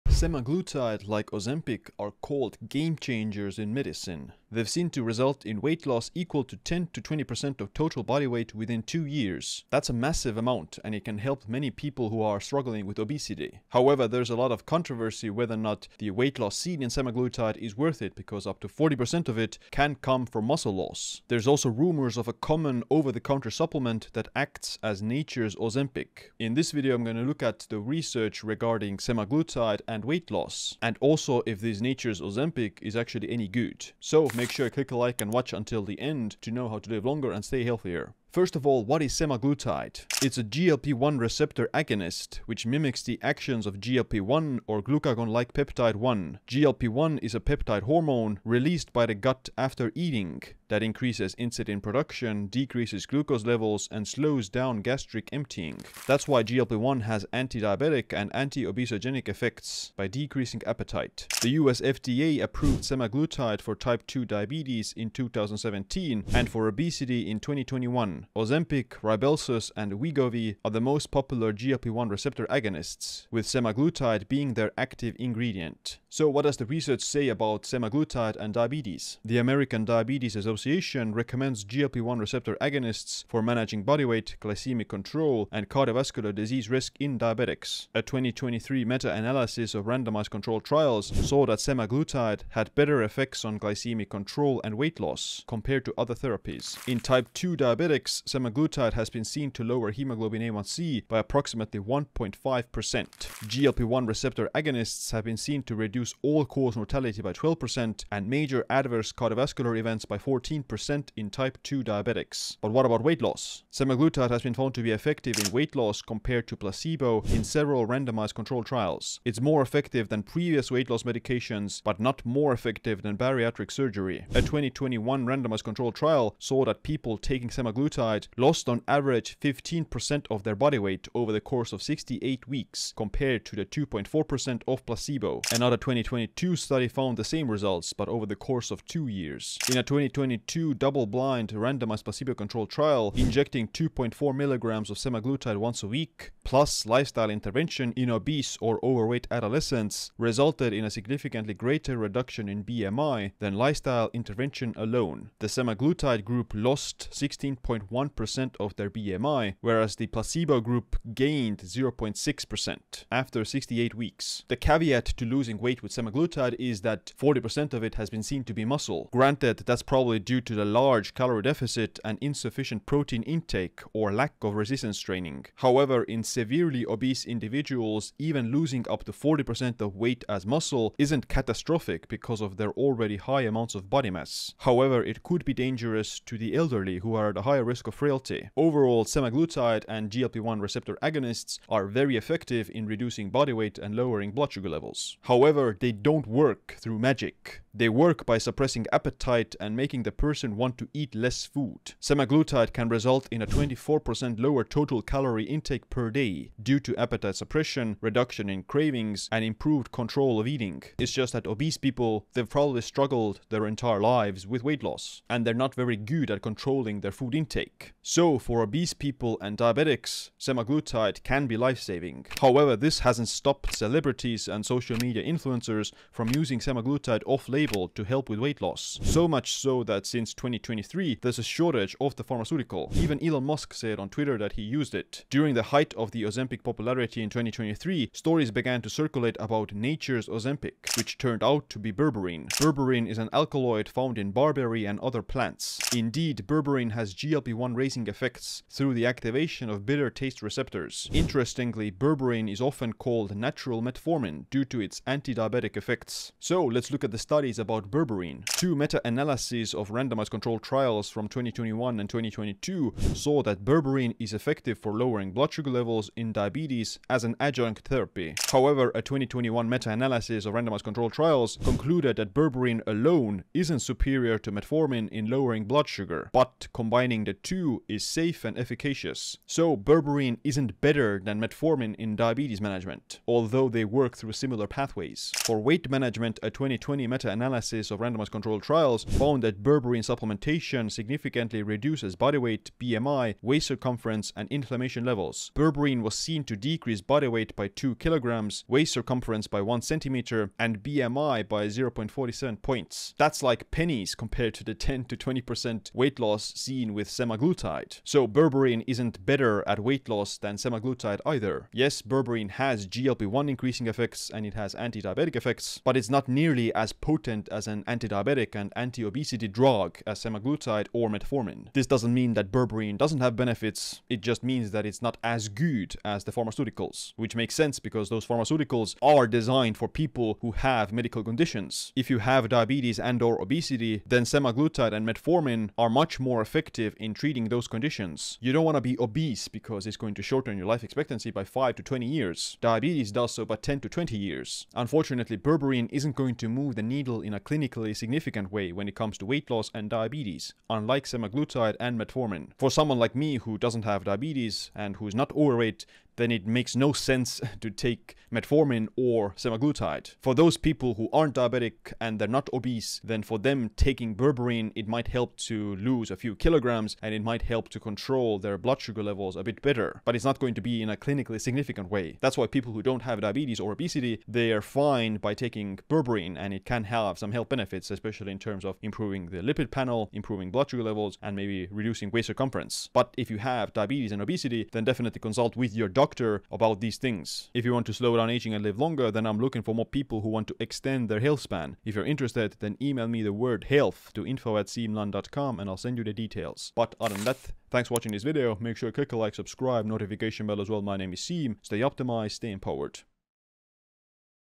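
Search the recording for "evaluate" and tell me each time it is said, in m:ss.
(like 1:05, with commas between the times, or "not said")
not said.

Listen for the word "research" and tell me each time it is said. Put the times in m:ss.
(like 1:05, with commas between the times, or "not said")
0:27, 1:16.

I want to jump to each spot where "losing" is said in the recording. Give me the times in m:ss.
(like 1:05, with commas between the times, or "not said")
2:45, 2:58.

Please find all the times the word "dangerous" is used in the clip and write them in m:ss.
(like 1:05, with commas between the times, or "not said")
3:05.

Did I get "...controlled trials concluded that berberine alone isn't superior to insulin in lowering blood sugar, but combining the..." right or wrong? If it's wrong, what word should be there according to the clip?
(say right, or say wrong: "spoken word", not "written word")
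wrong: "metformin", not "insulin".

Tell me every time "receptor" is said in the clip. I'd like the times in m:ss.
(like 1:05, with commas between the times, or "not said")
0:41, 1:12, 1:22, 1:44, 3:10, 4:10.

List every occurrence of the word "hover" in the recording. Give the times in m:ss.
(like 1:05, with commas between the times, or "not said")
not said.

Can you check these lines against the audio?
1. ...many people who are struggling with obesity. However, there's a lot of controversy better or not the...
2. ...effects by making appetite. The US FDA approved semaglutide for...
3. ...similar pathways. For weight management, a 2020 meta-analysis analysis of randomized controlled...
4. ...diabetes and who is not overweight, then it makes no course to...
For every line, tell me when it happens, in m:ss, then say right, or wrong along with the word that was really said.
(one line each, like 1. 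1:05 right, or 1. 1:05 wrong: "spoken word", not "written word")
1. 0:11 wrong: "whether", not "better"
2. 0:59 wrong: "decreasing", not "making"
3. 4:44 right
4. 5:54 wrong: "sense", not "course".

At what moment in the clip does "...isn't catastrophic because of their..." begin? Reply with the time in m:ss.
3:00.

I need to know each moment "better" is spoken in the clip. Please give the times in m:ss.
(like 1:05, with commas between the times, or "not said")
1:32, 4:40, 5:09, 6:09.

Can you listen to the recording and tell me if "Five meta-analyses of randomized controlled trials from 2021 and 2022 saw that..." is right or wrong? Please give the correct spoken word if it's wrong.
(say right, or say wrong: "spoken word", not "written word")
wrong: "Two", not "Five".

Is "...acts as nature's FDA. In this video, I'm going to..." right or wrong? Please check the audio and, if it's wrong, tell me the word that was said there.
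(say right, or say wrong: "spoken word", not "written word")
wrong: "Ozempic", not "FDA".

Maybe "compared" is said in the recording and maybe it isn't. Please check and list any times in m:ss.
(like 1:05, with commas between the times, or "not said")
1:35, 1:56, 2:13, 5:04.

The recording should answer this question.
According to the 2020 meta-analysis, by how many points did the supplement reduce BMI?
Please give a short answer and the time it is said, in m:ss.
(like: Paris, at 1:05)
0.47, at 5:01.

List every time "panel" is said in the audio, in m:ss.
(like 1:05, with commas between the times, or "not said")
6:19.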